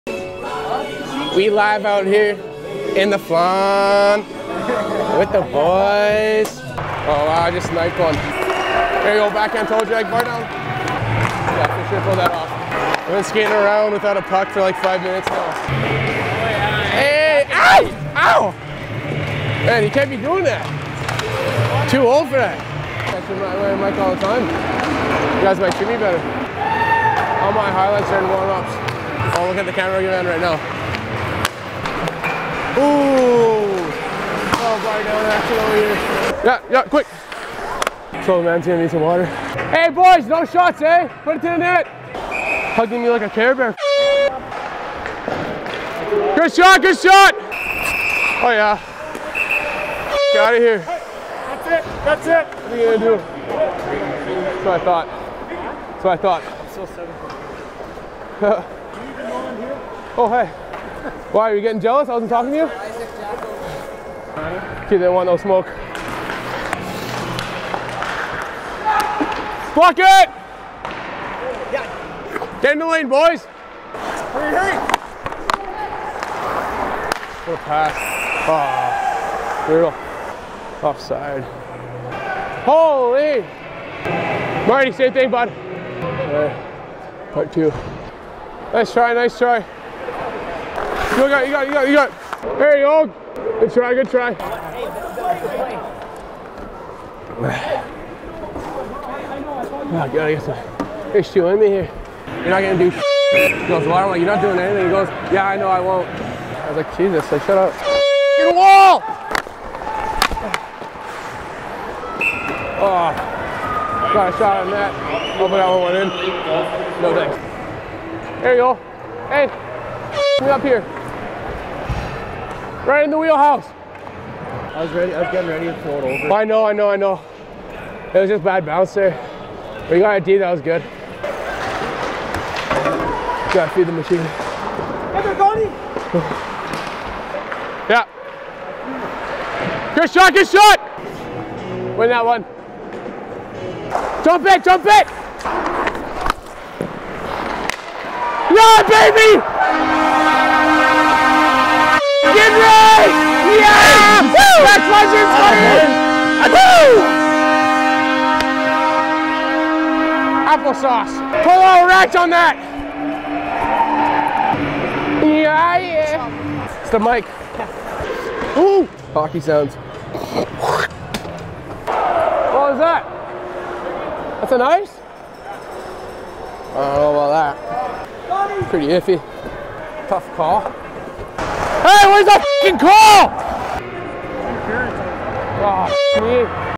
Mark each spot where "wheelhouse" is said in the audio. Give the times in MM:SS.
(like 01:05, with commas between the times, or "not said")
02:03.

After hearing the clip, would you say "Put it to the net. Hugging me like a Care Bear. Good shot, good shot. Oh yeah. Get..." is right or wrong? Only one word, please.
right.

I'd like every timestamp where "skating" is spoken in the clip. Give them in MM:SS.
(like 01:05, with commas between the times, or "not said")
00:13.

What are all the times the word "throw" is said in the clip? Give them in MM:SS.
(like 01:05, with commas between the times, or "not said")
02:05.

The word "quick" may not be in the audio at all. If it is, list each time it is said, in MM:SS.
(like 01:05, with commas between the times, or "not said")
00:36.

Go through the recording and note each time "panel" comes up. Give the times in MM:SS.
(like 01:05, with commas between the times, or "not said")
not said.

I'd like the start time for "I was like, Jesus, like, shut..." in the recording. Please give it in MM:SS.
01:46.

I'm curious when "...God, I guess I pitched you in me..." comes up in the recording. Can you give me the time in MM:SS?
01:40.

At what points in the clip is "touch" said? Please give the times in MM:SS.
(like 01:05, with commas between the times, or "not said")
not said.